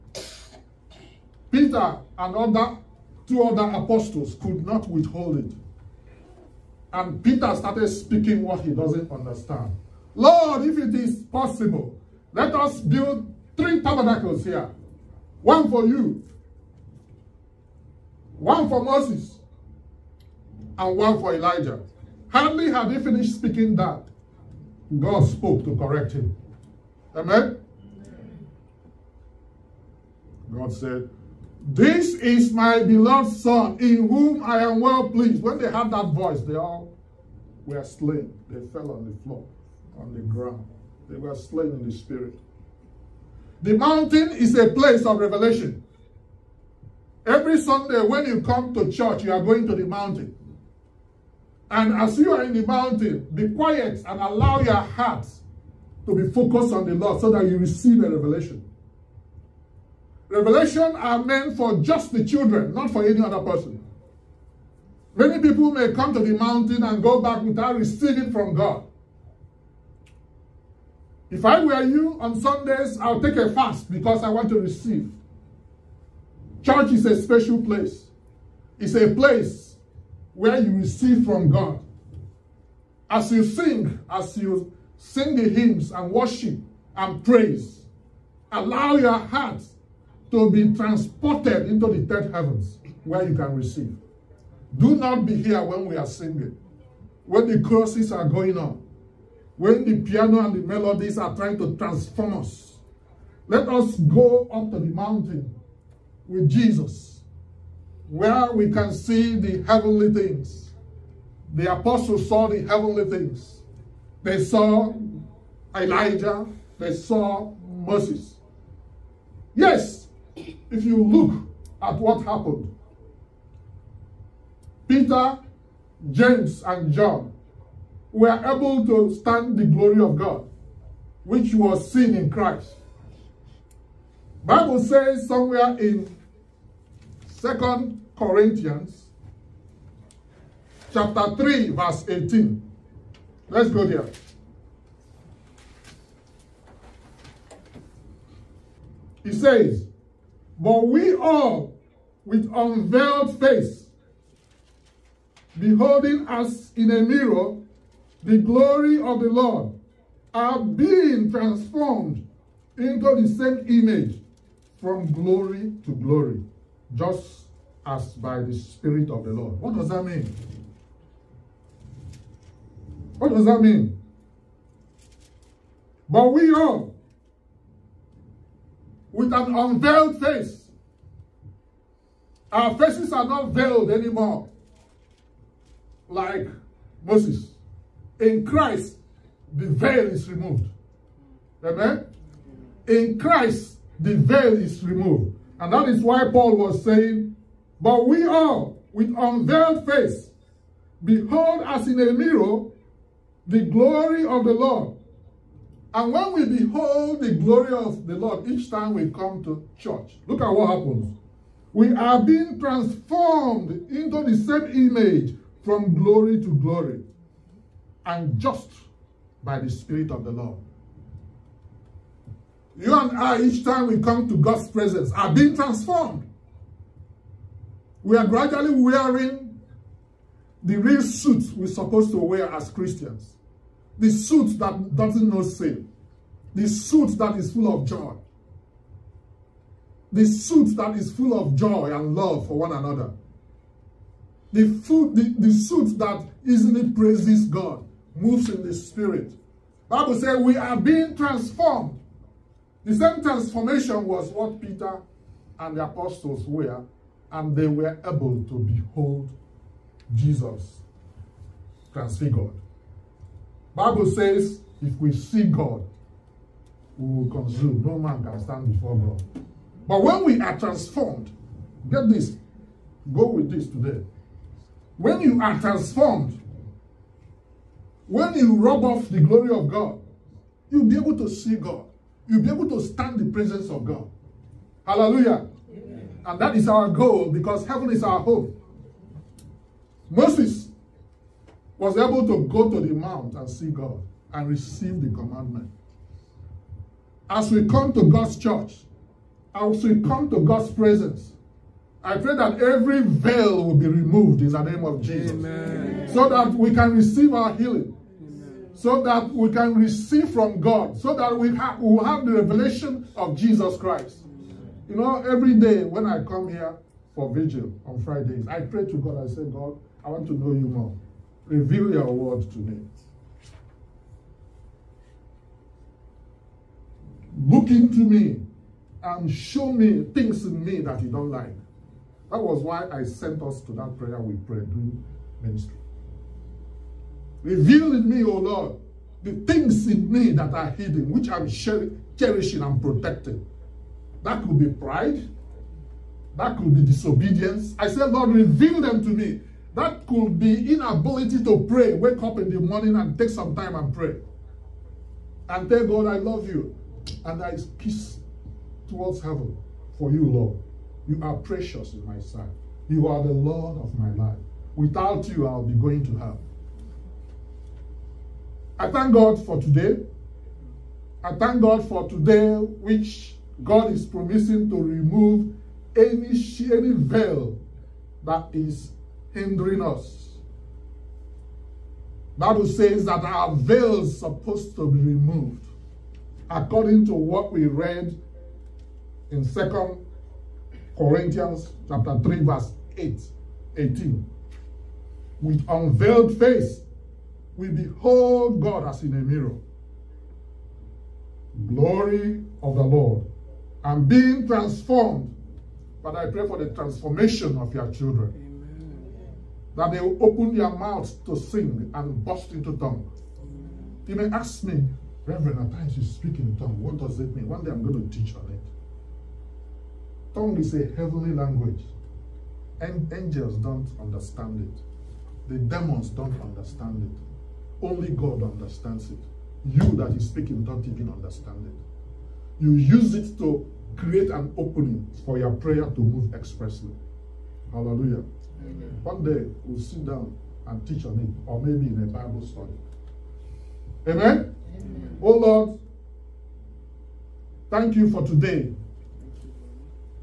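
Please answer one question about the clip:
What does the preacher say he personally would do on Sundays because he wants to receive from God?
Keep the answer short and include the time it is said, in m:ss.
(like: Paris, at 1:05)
Take a fast, at 1:13.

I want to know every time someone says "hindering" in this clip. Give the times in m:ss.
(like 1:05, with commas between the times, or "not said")
6:19.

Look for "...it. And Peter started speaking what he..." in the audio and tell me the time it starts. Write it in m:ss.
0:05.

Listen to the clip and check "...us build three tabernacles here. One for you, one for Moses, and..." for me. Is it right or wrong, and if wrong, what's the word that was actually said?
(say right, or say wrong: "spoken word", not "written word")
right.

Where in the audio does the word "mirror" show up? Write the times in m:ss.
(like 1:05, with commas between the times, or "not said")
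2:37, 3:22, 6:39.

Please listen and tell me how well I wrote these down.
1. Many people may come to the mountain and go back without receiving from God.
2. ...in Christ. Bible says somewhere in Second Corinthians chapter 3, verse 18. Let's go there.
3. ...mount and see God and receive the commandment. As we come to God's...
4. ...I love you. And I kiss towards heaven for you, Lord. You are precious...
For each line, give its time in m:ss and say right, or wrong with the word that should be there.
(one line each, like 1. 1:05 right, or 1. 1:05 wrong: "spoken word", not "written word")
1. 1:05 right
2. 2:12 right
3. 4:52 right
4. 5:56 right.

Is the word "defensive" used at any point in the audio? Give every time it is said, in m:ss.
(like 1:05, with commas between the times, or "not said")
not said.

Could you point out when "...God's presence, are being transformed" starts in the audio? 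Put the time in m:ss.
3:44.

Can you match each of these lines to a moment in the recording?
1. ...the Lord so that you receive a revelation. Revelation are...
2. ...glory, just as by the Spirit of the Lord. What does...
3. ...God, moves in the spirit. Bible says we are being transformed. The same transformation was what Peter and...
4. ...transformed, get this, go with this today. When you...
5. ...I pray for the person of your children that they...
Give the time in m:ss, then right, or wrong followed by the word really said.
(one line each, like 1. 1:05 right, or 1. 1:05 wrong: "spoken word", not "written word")
1. 0:56 right
2. 2:45 right
3. 4:07 right
4. 4:30 right
5. 6:46 wrong: "transformation", not "person".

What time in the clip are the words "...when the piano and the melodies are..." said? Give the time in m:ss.
1:39.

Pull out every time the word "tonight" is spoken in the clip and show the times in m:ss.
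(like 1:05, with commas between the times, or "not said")
5:22.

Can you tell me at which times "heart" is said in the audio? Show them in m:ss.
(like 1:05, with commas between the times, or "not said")
0:54, 1:29.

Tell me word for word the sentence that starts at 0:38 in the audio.
They fell on the floor, on the ground.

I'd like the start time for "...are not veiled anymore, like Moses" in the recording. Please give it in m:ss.
3:03.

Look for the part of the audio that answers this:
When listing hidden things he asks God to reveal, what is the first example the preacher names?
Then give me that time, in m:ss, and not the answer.
5:44.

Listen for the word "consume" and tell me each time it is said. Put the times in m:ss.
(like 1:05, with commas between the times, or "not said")
4:27.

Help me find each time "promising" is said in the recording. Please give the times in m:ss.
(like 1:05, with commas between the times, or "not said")
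6:14.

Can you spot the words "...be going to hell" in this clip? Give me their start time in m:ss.
6:05.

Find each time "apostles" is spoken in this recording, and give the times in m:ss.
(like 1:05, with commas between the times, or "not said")
0:03, 1:51, 4:15.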